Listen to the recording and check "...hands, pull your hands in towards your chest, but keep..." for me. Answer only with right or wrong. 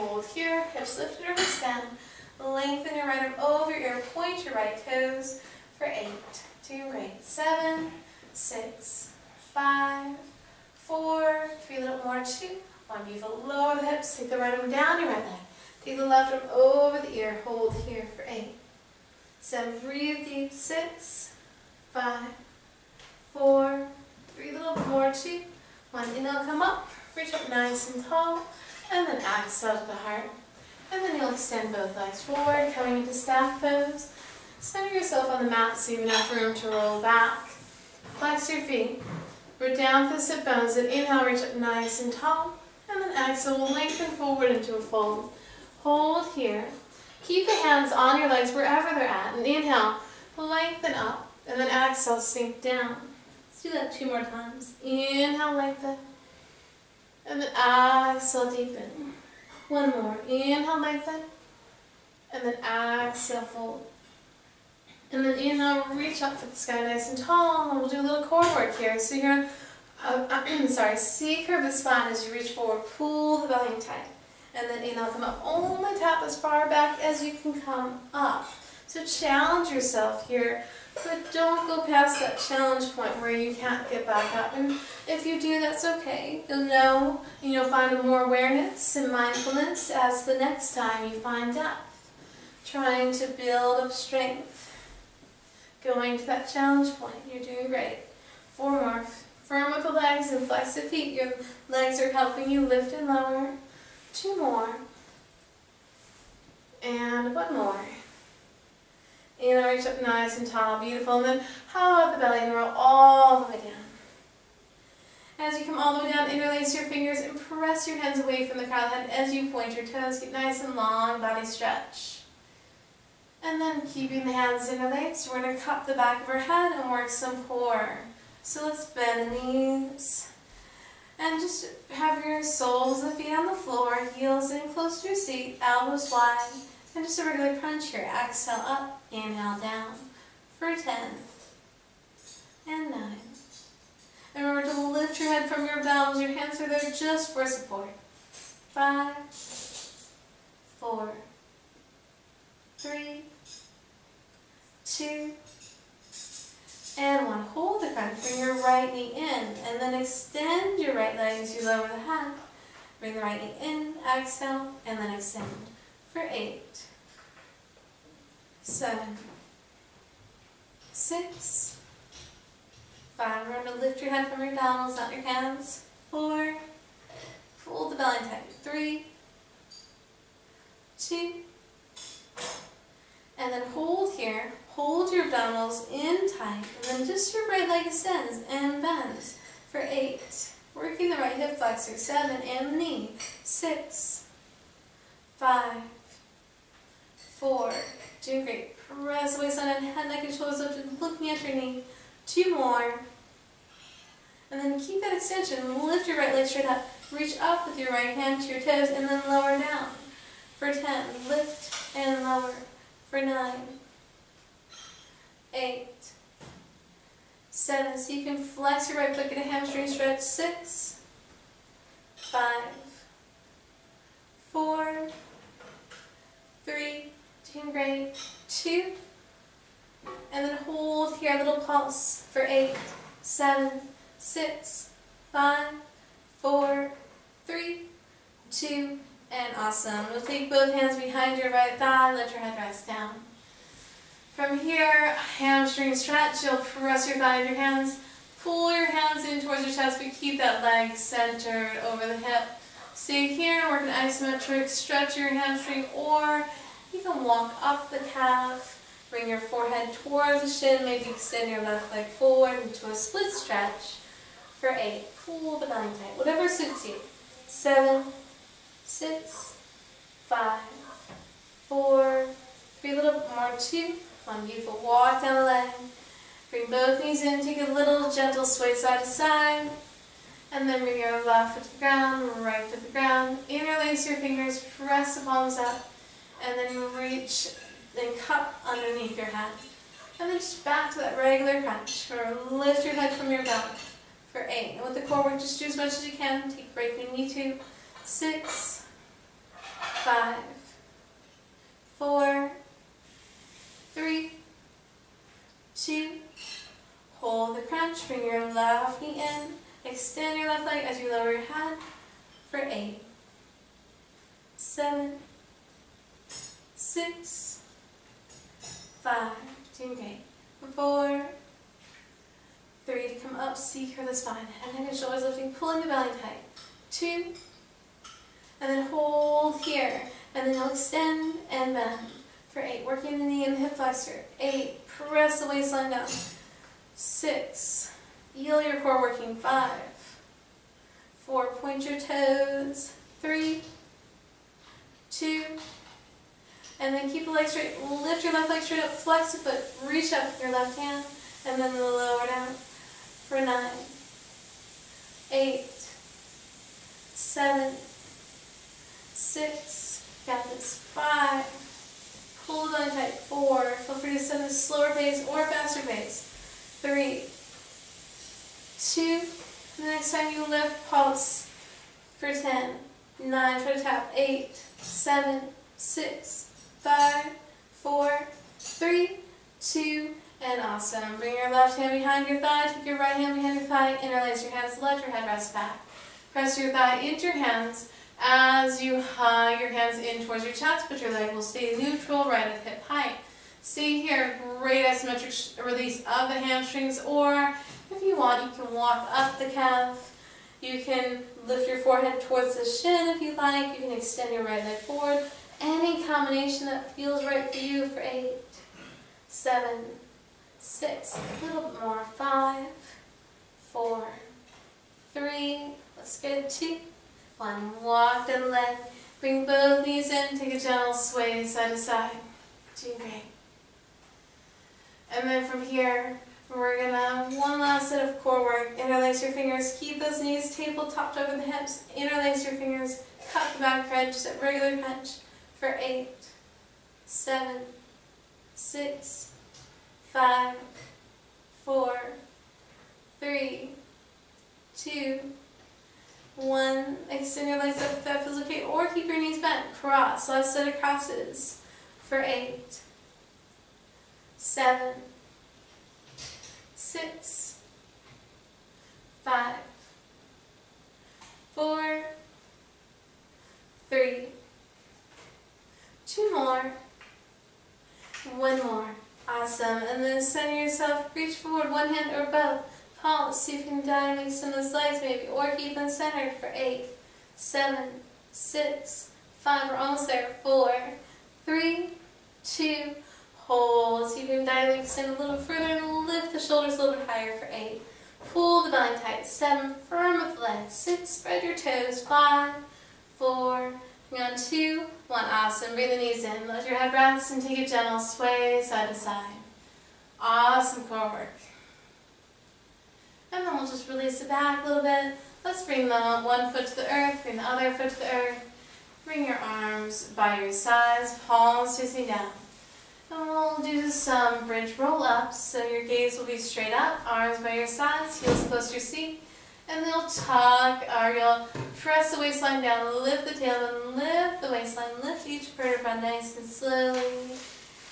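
right.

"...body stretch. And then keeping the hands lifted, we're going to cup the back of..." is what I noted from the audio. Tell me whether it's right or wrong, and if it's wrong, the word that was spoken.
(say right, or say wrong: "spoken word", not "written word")
wrong: "interlaced", not "lifted".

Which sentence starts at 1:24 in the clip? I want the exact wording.
And if you do, that's okay.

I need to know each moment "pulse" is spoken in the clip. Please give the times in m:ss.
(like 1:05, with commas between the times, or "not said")
3:51, 6:10.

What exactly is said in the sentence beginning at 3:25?
Lift your right leg straight up.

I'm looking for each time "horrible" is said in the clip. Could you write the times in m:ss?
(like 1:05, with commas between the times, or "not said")
not said.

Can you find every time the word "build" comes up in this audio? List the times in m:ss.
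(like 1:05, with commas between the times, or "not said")
1:33.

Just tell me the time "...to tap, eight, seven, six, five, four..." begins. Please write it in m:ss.
6:13.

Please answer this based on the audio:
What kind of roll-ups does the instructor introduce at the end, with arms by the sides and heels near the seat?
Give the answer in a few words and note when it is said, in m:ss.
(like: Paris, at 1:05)
bridge roll-ups, at 8:34.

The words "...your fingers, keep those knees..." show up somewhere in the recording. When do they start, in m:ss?
7:09.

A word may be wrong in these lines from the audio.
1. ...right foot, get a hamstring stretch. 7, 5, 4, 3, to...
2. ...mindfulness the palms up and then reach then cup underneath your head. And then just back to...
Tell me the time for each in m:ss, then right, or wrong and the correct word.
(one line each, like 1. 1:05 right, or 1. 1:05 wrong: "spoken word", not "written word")
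1. 3:38 wrong: "6", not "7"
2. 4:44 wrong: "press", not "mindfulness".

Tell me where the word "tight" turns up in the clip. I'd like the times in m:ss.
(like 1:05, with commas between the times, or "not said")
1:13, 2:58, 3:06, 4:25, 5:26, 6:02, 8:08.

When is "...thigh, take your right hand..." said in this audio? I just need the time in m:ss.
6:22.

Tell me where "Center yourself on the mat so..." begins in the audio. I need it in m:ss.
0:34.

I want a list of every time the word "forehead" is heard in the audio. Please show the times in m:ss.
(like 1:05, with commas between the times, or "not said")
4:19, 6:41.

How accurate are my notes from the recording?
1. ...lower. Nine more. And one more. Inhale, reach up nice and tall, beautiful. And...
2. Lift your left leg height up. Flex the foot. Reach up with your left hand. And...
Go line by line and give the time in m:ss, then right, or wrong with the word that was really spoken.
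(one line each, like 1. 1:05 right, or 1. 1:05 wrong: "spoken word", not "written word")
1. 1:43 wrong: "Two", not "Nine"
2. 5:47 wrong: "straight", not "height".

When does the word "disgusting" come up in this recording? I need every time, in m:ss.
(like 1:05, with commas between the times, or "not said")
not said.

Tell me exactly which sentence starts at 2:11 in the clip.
And just have your soles of the feet on the floor, heels in close to your seat, elbows wide.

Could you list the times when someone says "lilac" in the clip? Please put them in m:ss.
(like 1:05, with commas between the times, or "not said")
not said.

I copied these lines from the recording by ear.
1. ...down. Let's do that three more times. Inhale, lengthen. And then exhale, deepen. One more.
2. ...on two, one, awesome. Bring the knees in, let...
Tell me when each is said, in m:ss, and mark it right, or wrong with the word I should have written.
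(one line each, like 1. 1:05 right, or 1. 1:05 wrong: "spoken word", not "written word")
1. 0:52 wrong: "two", not "three"
2. 8:14 right.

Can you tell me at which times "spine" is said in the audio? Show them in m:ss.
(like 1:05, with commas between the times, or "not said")
1:11, 5:24.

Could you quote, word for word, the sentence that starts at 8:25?
Let's bring the one foot to the earth, bring the other foot to the earth.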